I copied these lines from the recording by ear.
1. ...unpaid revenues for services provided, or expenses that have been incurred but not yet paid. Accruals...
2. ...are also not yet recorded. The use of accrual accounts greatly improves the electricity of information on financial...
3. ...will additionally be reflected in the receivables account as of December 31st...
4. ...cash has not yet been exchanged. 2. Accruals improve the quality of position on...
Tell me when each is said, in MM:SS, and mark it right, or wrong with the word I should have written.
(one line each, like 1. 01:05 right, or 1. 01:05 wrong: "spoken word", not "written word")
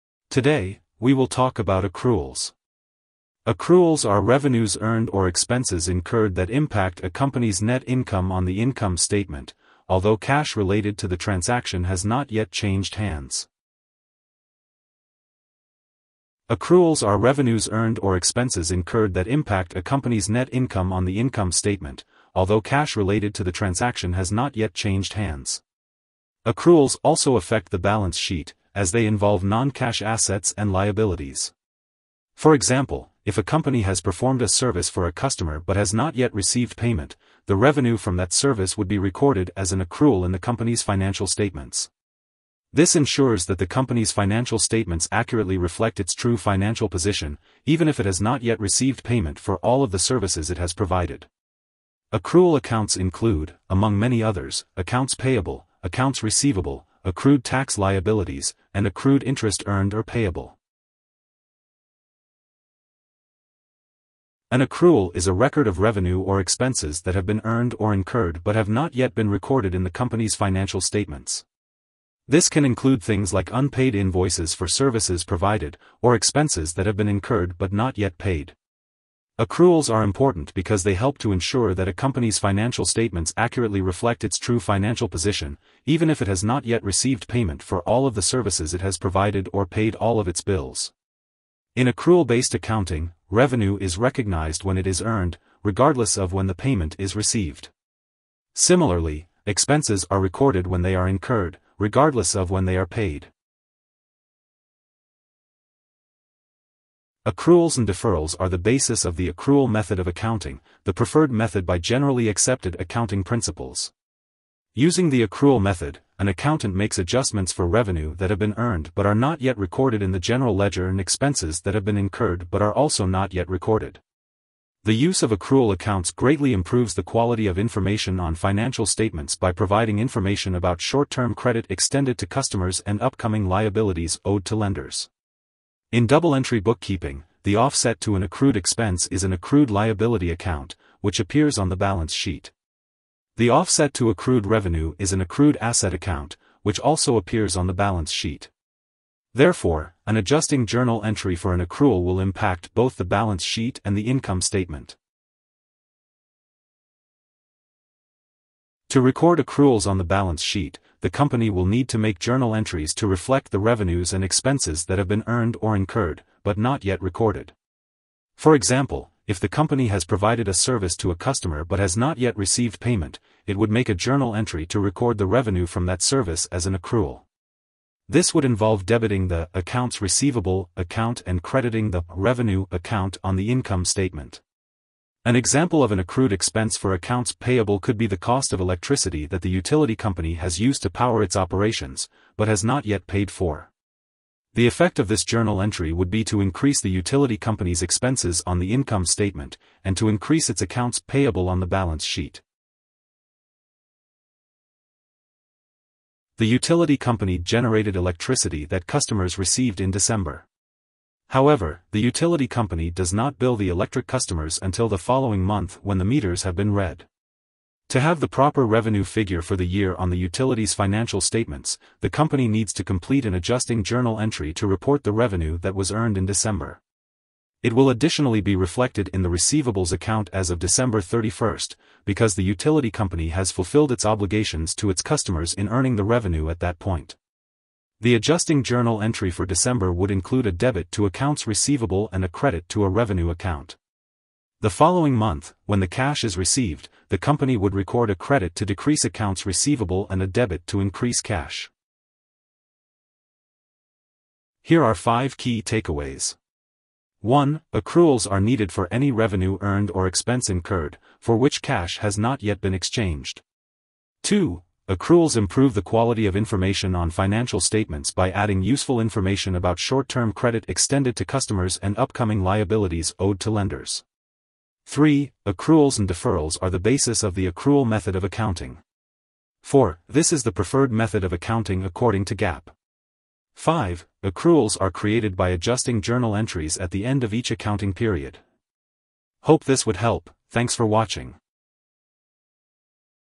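1. 01:13 wrong: "invoices", not "revenues"
2. 02:02 wrong: "quality", not "electricity"
3. 03:47 right
4. 04:21 wrong: "information", not "position".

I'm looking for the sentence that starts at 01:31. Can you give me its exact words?
In accrual-based accounting, revenue is recognized when it is earned, regardless of when the payment is received.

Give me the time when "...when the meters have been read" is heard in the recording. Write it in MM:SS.
03:35.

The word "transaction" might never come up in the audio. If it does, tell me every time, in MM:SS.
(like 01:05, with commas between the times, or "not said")
00:11, 00:23.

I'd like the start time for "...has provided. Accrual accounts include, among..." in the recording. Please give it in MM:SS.
00:50.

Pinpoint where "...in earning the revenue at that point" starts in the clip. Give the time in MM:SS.
03:55.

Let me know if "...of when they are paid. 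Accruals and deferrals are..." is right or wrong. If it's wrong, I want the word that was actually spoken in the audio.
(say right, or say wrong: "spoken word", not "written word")
right.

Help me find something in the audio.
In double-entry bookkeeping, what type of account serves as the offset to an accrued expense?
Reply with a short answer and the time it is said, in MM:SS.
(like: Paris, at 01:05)
accrued liability account, at 02:19.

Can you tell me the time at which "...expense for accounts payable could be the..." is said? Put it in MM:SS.
03:06.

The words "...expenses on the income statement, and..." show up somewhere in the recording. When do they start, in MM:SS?
03:17.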